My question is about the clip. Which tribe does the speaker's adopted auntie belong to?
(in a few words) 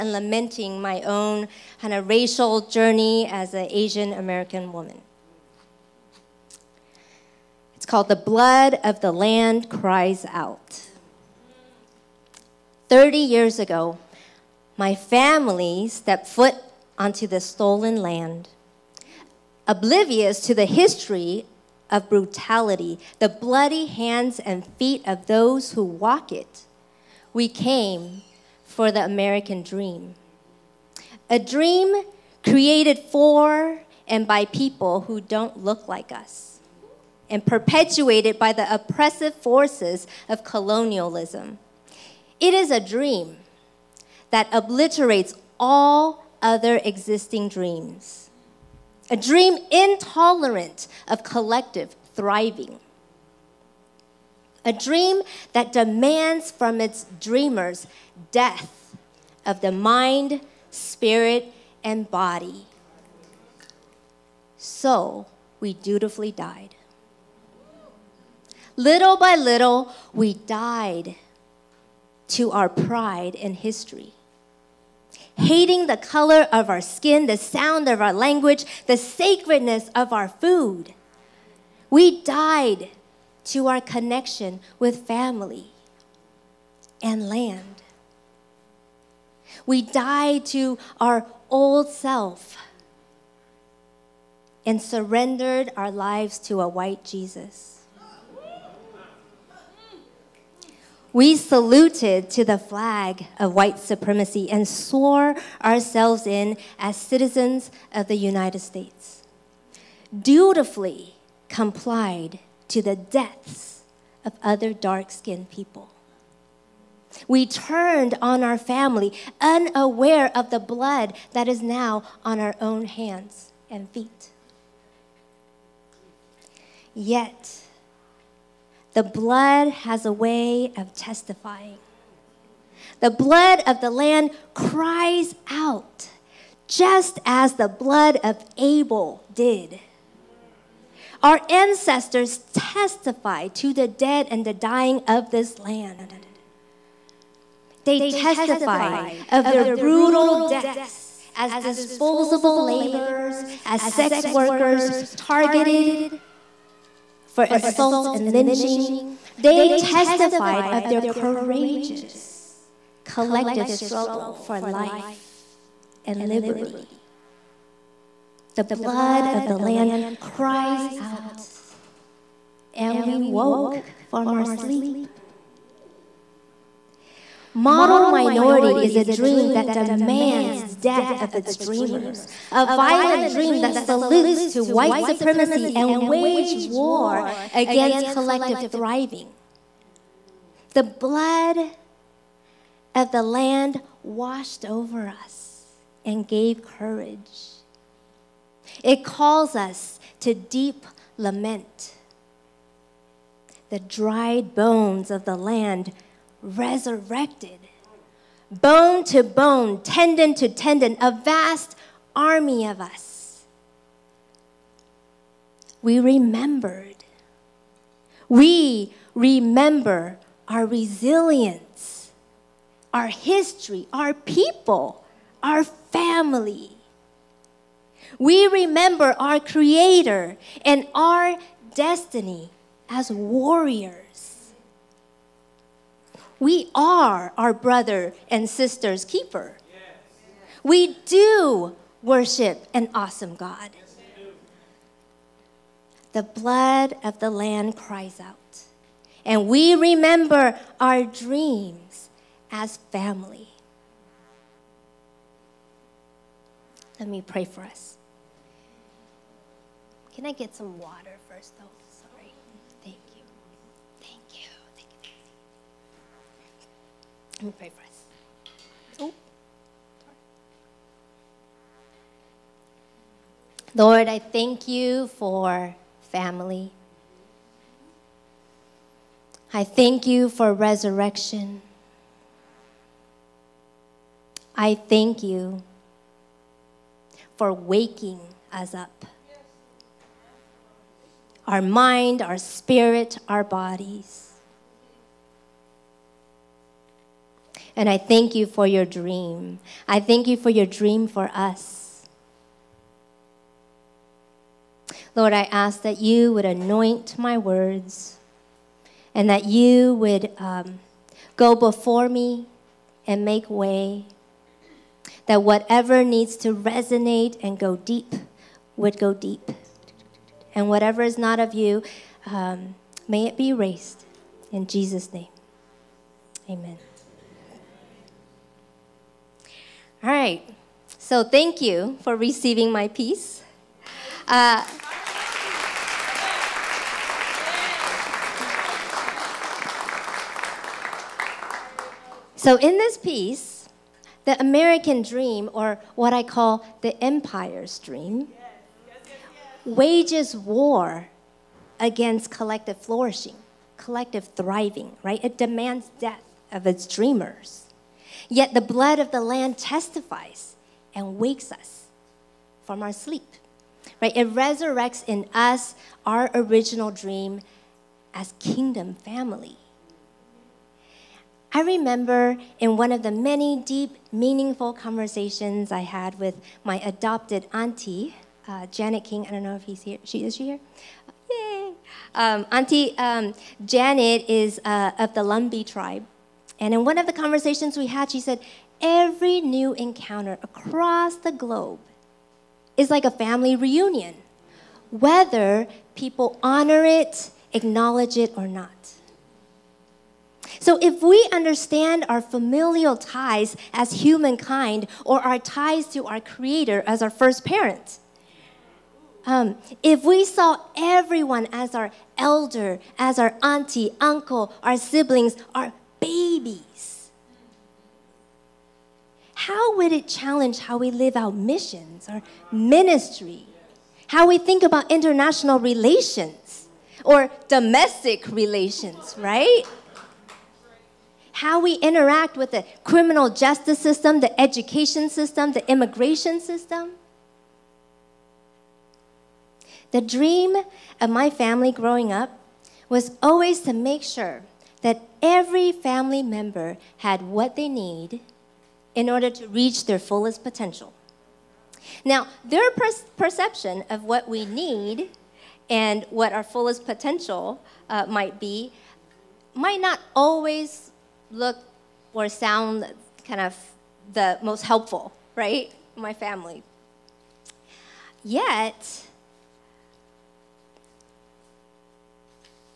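Lumbee.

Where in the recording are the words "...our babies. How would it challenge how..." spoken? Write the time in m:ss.
6:55.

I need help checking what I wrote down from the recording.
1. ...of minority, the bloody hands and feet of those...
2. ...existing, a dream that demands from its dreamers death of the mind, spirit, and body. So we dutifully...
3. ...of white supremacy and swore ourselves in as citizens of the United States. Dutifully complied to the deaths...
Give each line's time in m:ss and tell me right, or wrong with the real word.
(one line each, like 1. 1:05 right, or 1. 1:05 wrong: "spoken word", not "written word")
1. 0:21 wrong: "brutality", not "minority"
2. 0:52 wrong: "thriving", not "existing"
3. 1:43 right.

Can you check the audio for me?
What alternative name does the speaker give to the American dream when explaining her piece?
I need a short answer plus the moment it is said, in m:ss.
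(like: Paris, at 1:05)
the empire's dream, at 5:46.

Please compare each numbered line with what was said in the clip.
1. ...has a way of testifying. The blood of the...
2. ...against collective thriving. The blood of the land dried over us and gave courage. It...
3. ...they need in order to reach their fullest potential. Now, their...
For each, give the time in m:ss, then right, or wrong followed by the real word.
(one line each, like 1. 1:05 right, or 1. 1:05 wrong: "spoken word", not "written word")
1. 2:09 right
2. 3:07 wrong: "washed", not "dried"
3. 7:27 right.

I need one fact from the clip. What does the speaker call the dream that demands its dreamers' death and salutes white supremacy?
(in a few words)
Model minority.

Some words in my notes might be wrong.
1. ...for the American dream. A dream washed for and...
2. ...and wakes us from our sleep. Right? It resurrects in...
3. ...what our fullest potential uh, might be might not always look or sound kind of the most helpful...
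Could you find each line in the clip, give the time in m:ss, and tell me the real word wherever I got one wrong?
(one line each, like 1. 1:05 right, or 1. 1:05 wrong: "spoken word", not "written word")
1. 0:28 wrong: "created", not "washed"
2. 6:00 right
3. 7:36 right.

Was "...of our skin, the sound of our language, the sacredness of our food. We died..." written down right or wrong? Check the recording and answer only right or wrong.
right.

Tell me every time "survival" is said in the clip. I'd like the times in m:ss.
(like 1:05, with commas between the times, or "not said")
not said.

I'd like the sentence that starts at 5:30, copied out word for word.
So thank you for receiving my piece.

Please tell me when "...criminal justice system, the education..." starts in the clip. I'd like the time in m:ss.
7:12.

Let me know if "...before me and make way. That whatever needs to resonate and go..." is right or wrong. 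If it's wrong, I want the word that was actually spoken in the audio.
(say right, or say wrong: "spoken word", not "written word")
right.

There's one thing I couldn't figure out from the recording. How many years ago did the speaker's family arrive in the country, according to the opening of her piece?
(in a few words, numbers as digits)
30.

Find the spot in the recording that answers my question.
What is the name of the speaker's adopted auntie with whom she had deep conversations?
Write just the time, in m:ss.
6:18.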